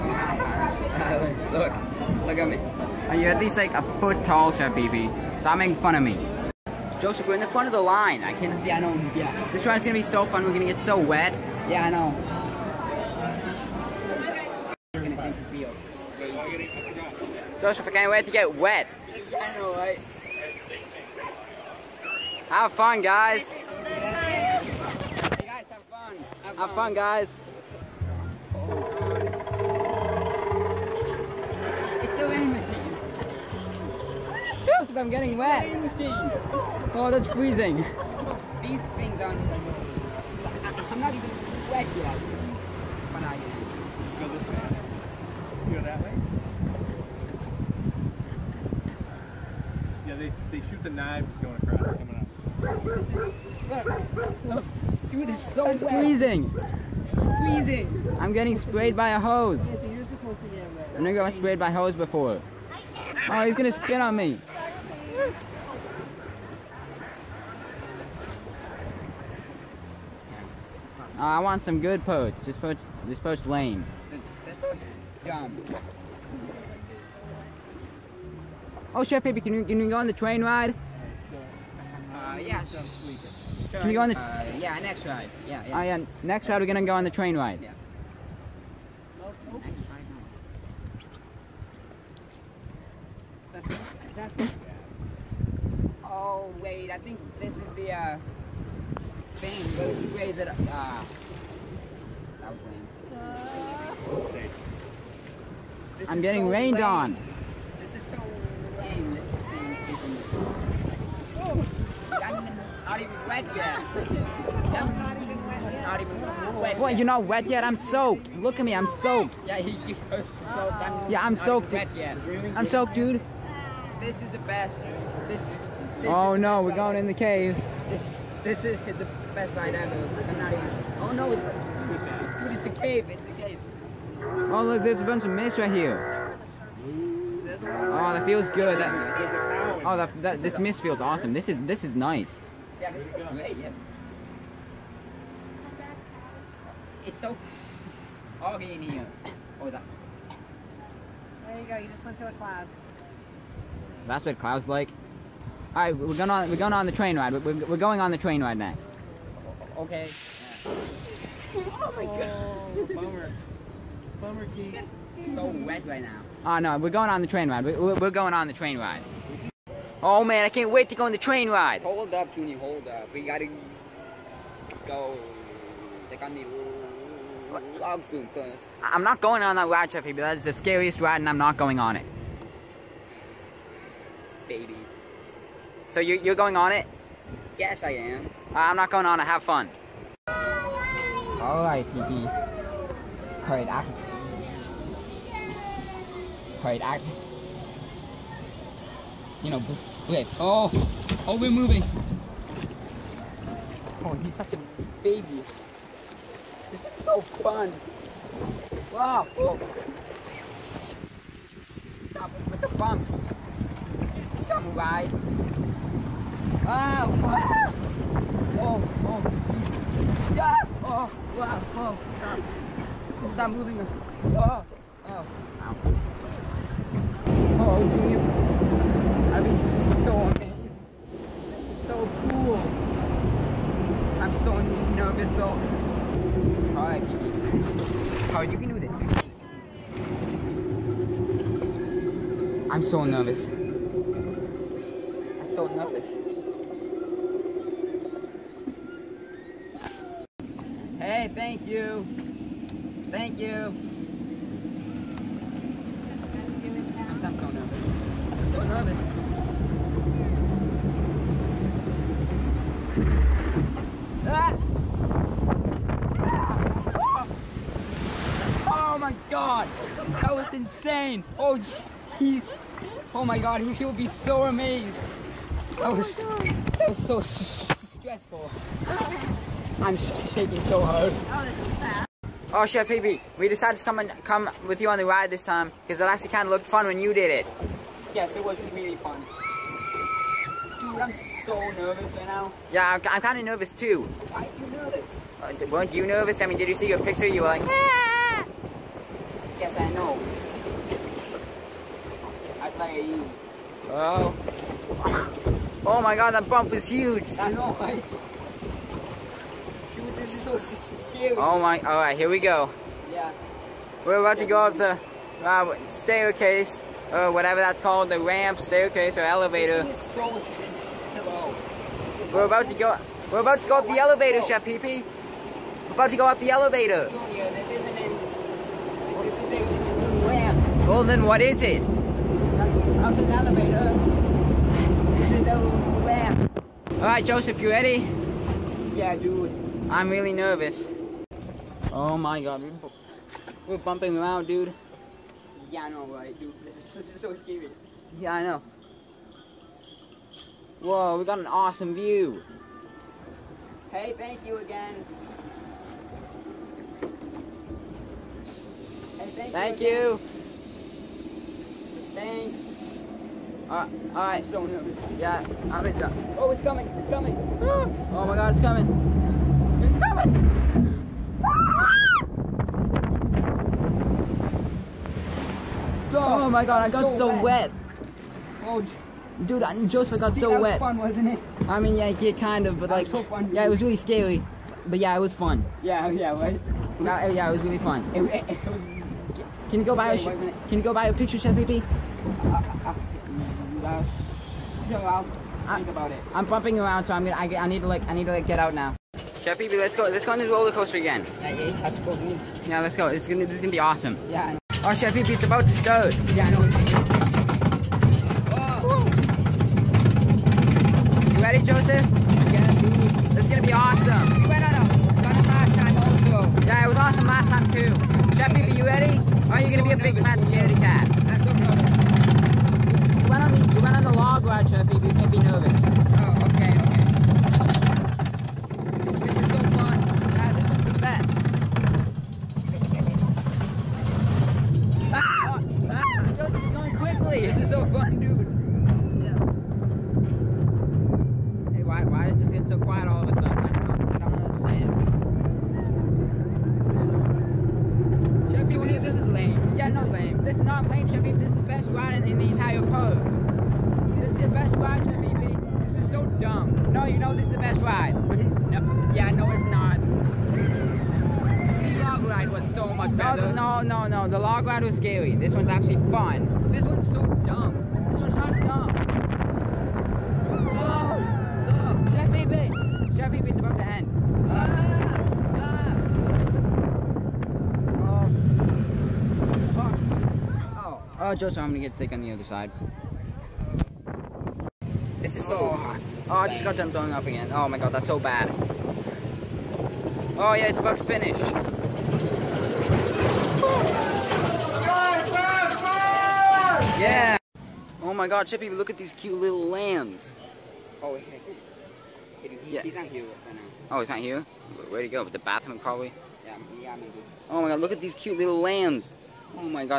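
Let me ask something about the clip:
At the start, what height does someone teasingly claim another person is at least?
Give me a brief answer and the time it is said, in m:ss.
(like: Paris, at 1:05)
a foot tall, at 0:03.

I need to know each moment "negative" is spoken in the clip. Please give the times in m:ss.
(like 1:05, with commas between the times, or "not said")
not said.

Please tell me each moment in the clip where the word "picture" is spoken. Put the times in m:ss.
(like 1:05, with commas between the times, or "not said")
4:56, 6:31.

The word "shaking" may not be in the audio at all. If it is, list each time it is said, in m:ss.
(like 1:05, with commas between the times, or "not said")
4:39.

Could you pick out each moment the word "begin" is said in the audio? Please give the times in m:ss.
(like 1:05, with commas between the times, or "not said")
not said.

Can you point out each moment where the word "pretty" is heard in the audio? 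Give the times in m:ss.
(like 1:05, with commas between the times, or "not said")
not said.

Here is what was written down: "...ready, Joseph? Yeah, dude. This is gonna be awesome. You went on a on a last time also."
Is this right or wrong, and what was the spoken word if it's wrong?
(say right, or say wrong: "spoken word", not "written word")
right.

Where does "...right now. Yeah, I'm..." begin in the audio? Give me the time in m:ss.
4:52.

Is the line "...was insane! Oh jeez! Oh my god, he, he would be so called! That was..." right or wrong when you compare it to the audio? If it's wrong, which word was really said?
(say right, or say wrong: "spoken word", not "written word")
wrong: "amazed", not "called".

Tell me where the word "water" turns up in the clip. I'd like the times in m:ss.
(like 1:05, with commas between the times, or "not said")
not said.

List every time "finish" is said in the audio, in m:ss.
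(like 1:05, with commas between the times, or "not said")
8:11.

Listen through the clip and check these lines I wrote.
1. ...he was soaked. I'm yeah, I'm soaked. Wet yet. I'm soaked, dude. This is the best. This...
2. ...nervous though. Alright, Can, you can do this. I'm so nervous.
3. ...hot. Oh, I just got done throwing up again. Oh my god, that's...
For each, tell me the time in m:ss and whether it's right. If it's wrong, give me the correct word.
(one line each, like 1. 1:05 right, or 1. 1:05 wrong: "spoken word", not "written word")
1. 1:59 right
2. 3:54 wrong: "Alright", not "Can"
3. 8:05 right.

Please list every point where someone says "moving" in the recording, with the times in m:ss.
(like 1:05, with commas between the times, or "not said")
3:21, 3:43.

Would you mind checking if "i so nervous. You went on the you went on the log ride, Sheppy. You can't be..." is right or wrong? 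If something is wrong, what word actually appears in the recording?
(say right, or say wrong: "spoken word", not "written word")
right.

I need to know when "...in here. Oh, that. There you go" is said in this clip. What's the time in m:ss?
2:28.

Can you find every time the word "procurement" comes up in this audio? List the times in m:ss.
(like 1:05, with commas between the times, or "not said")
not said.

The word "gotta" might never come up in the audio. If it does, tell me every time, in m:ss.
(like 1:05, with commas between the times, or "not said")
2:53.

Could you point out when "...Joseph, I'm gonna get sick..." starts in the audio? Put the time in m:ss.
8:01.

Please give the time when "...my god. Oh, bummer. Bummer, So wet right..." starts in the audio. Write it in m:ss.
2:41.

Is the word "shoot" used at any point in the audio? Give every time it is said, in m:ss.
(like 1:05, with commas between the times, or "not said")
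0:50.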